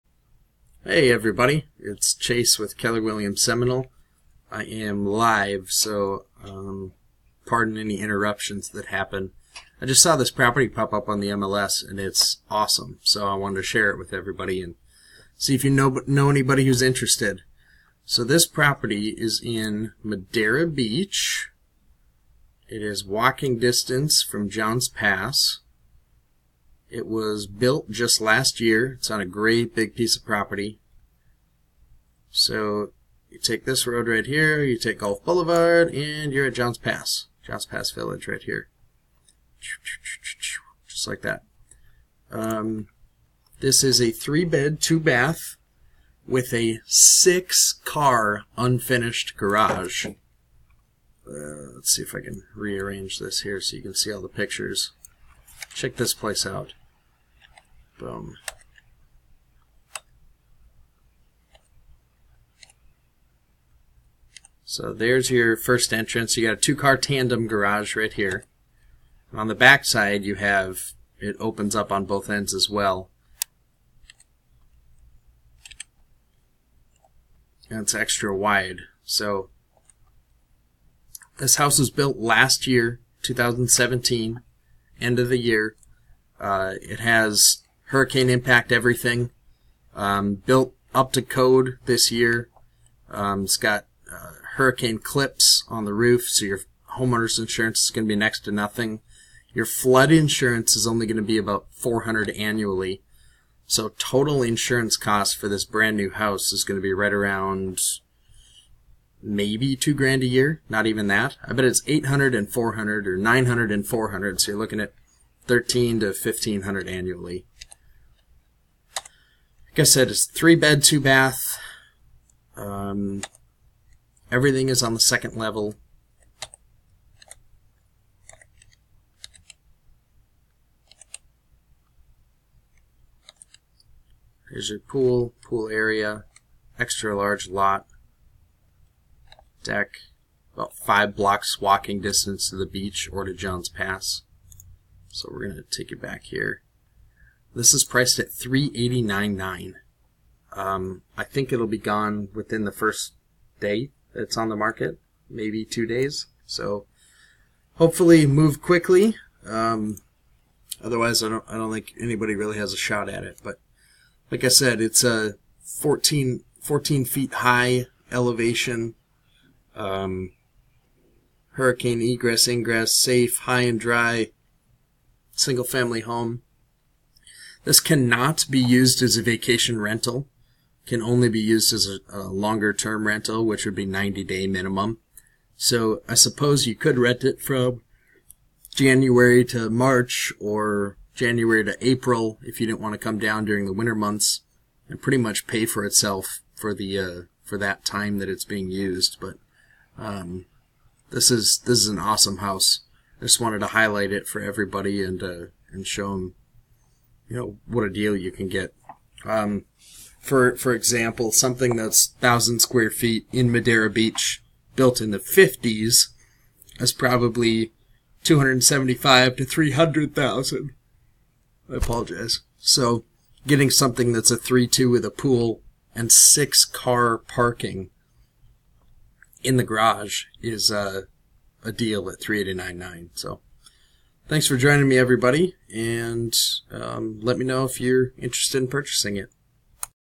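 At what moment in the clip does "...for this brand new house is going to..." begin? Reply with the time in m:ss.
1:45.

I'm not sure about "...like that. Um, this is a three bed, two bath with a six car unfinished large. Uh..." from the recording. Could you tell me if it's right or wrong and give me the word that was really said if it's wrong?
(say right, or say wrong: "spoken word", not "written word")
wrong: "garage", not "large".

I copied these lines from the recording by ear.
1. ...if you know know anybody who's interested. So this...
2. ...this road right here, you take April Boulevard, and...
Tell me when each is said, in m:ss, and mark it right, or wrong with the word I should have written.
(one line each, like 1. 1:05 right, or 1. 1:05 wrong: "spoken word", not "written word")
1. 0:15 right
2. 0:33 wrong: "Gulf", not "April".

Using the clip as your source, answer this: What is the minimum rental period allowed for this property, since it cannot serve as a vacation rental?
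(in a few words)
90 days.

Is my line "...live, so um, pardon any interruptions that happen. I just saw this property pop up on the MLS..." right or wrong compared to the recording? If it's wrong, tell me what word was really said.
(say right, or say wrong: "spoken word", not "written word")
right.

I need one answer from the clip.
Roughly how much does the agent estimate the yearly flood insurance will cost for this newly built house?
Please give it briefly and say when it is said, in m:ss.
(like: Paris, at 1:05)
$400, at 1:41.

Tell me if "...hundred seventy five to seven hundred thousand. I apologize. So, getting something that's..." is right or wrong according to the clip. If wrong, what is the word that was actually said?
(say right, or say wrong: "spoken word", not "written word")
wrong: "three", not "seven".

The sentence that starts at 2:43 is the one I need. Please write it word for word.
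But like I said, it's a 14, 14 feet high elevation.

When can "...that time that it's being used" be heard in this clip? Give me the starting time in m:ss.
3:17.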